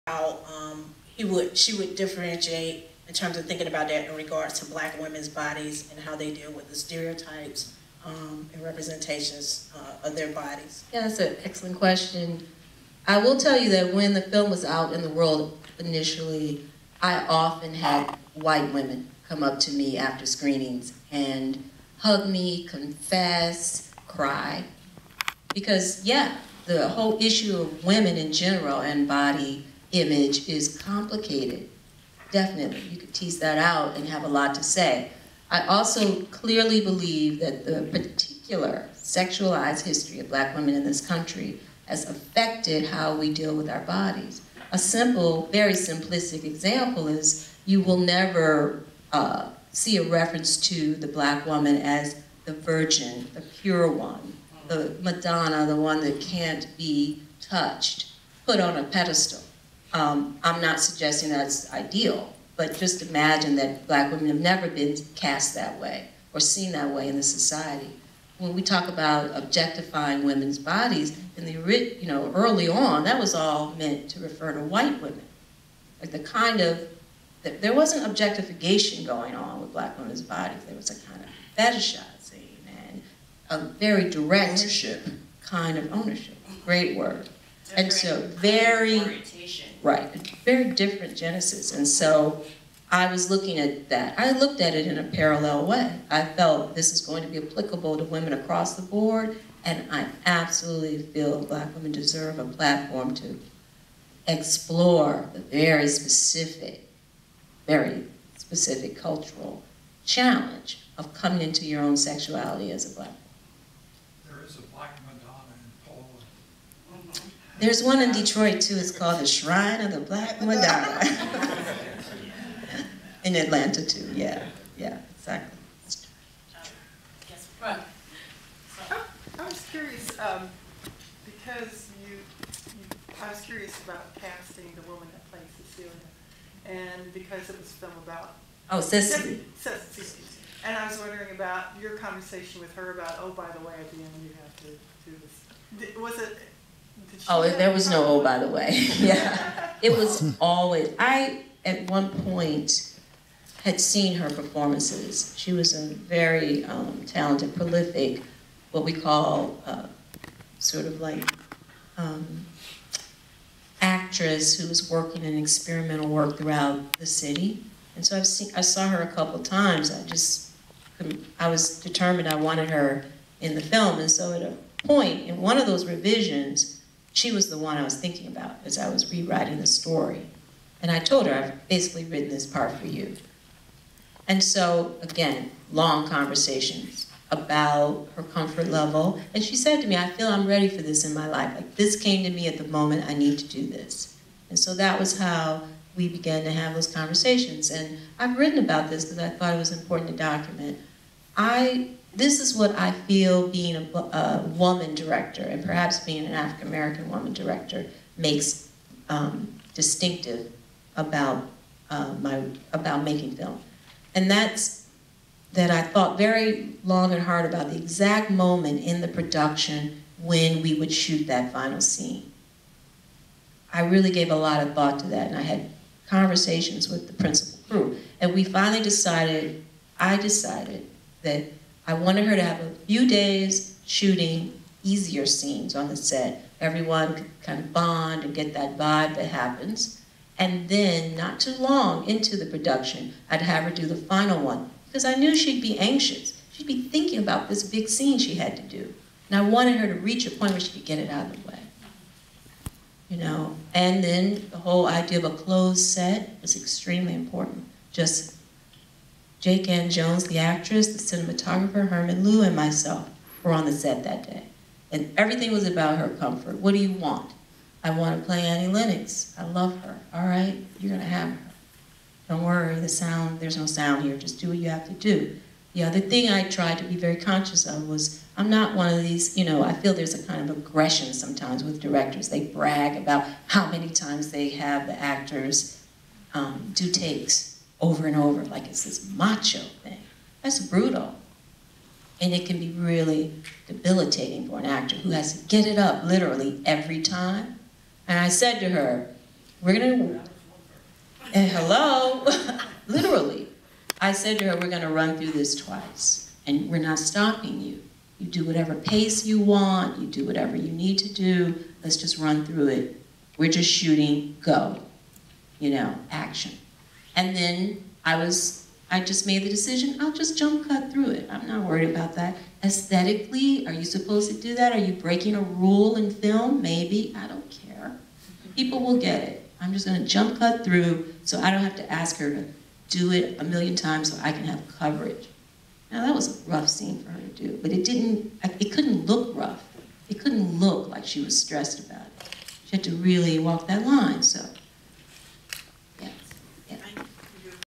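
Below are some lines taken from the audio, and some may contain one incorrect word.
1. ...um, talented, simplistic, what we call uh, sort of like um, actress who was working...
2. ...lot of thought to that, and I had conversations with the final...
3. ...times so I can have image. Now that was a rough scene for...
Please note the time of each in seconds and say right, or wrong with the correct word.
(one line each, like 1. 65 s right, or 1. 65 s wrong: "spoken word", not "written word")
1. 156 s wrong: "prolific", not "simplistic"
2. 224 s wrong: "principal", not "final"
3. 333 s wrong: "coverage", not "image".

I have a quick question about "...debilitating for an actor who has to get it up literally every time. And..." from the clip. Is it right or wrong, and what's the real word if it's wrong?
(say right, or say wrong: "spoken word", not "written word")
right.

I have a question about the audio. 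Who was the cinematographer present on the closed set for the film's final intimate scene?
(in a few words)
Herman Liu.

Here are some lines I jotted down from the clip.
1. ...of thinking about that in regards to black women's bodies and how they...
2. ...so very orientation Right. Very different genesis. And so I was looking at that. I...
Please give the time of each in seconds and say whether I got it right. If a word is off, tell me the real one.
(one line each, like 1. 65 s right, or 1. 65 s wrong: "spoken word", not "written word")
1. 3 s right
2. 87 s right.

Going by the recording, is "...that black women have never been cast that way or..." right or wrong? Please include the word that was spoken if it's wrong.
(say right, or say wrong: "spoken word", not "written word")
right.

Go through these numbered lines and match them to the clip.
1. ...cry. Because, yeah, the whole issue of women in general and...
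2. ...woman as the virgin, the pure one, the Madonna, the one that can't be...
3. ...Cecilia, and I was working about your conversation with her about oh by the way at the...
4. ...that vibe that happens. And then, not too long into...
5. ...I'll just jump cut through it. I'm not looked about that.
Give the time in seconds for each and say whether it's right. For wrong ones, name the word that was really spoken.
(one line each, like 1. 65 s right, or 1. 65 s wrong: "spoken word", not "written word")
1. 24 s right
2. 51 s right
3. 139 s wrong: "wondering", not "working"
4. 238 s right
5. 319 s wrong: "worried", not "looked".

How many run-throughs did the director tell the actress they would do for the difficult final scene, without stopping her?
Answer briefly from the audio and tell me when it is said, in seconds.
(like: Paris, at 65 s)
2, at 305 s.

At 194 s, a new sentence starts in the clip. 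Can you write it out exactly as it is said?
And so that was how we began to have those conversations.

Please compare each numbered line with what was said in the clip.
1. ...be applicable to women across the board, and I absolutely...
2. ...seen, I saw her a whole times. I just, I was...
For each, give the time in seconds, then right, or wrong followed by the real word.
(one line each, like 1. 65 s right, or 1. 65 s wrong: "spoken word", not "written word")
1. 97 s right
2. 168 s wrong: "couple", not "whole".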